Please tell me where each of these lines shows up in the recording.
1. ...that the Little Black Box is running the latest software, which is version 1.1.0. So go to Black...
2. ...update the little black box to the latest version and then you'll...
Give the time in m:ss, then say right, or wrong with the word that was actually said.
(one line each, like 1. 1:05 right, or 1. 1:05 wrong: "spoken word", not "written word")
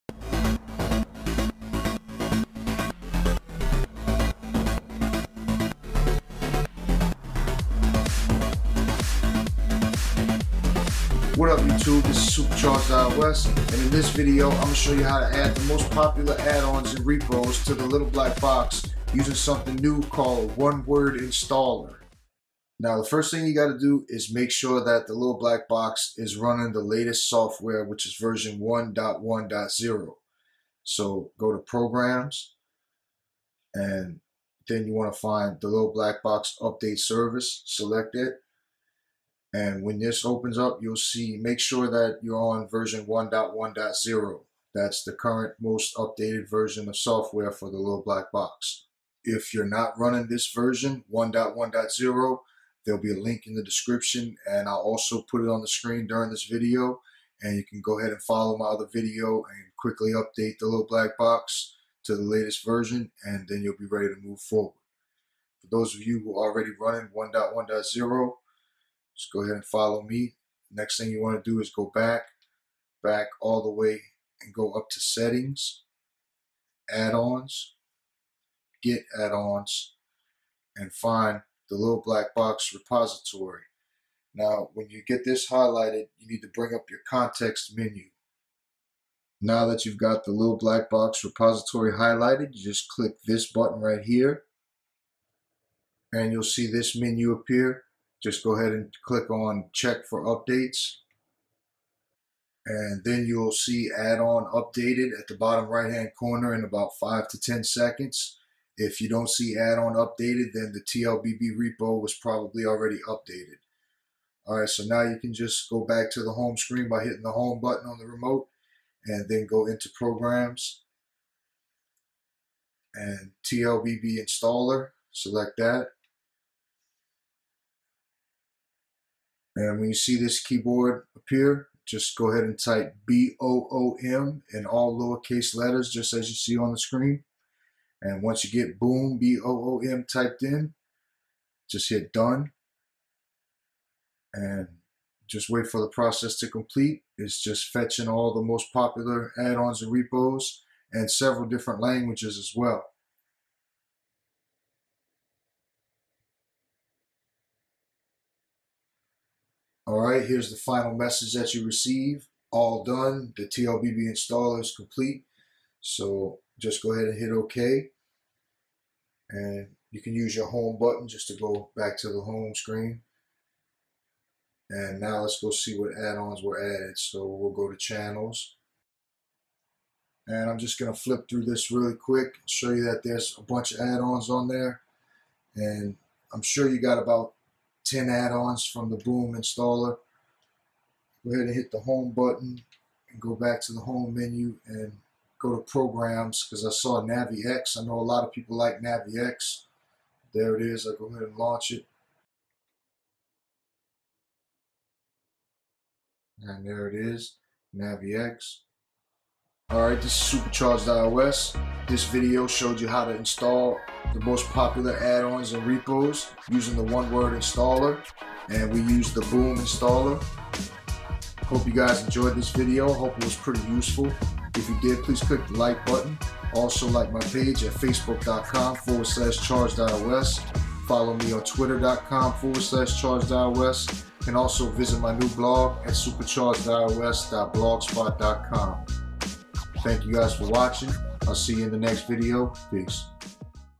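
1. 0:24 wrong: "Programs", not "Black"
2. 1:00 right.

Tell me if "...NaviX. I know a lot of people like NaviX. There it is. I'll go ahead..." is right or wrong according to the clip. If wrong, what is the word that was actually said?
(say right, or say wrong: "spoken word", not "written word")
right.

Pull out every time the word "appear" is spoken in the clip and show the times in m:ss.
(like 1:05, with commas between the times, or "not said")
1:37, 2:11.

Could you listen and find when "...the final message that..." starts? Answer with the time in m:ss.
2:40.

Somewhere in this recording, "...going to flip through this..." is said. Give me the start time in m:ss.
3:00.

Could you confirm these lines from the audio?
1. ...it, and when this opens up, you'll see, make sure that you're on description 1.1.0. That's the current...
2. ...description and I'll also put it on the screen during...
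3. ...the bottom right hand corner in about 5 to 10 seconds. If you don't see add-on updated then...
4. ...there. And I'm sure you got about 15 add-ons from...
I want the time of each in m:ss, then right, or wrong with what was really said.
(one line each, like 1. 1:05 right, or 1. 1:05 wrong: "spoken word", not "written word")
1. 0:38 wrong: "version", not "description"
2. 0:53 right
3. 1:45 right
4. 3:04 wrong: "10", not "15".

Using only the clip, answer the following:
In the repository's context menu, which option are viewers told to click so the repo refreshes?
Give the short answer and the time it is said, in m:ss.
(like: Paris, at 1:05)
Check for updates, at 1:39.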